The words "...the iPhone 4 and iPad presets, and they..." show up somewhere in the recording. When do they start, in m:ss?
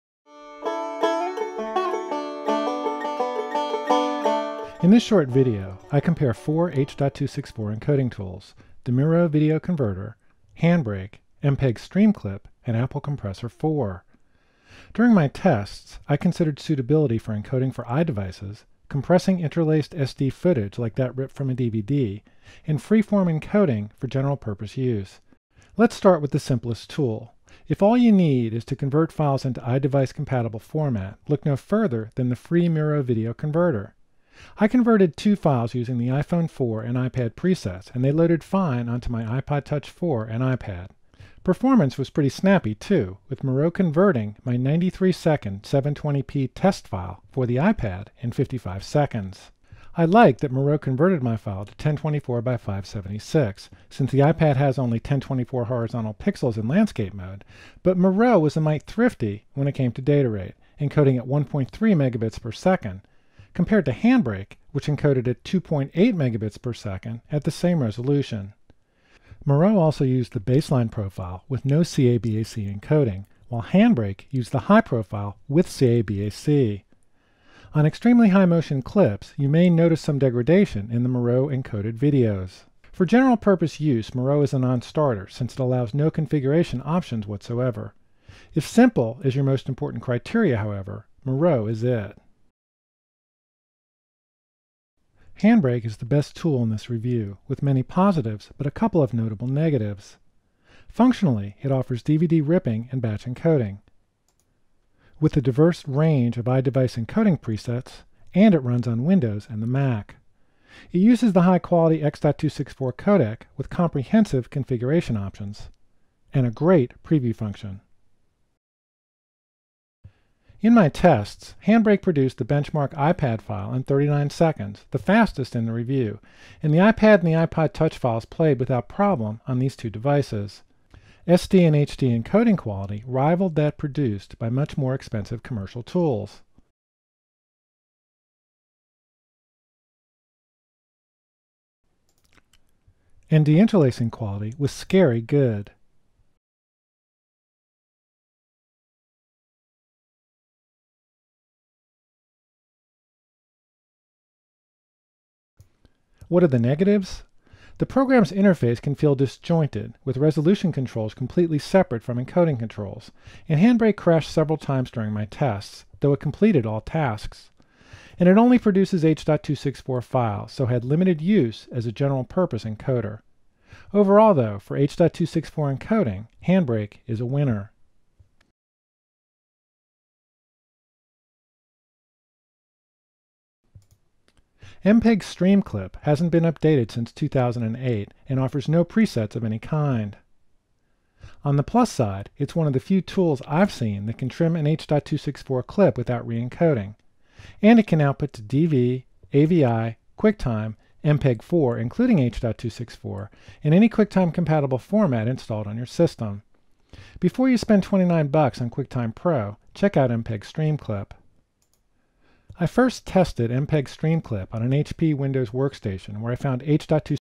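0:35.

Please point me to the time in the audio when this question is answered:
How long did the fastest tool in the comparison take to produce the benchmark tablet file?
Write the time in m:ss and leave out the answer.
2:03.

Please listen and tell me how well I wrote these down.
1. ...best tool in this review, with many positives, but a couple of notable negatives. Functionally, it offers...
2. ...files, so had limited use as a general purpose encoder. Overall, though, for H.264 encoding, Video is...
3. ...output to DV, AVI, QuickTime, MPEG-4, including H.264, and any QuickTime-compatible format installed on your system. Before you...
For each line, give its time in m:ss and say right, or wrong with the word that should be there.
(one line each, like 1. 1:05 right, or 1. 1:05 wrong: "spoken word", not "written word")
1. 1:36 right
2. 2:50 wrong: "Handbrake", not "Video"
3. 3:18 right.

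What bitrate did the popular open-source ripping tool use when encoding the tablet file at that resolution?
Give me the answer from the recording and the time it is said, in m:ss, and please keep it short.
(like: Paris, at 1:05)
2.8 megabits per second, at 1:05.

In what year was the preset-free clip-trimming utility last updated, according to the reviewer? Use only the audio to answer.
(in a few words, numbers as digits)
2008.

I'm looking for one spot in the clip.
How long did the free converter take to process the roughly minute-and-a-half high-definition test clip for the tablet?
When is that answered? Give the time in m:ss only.
0:48.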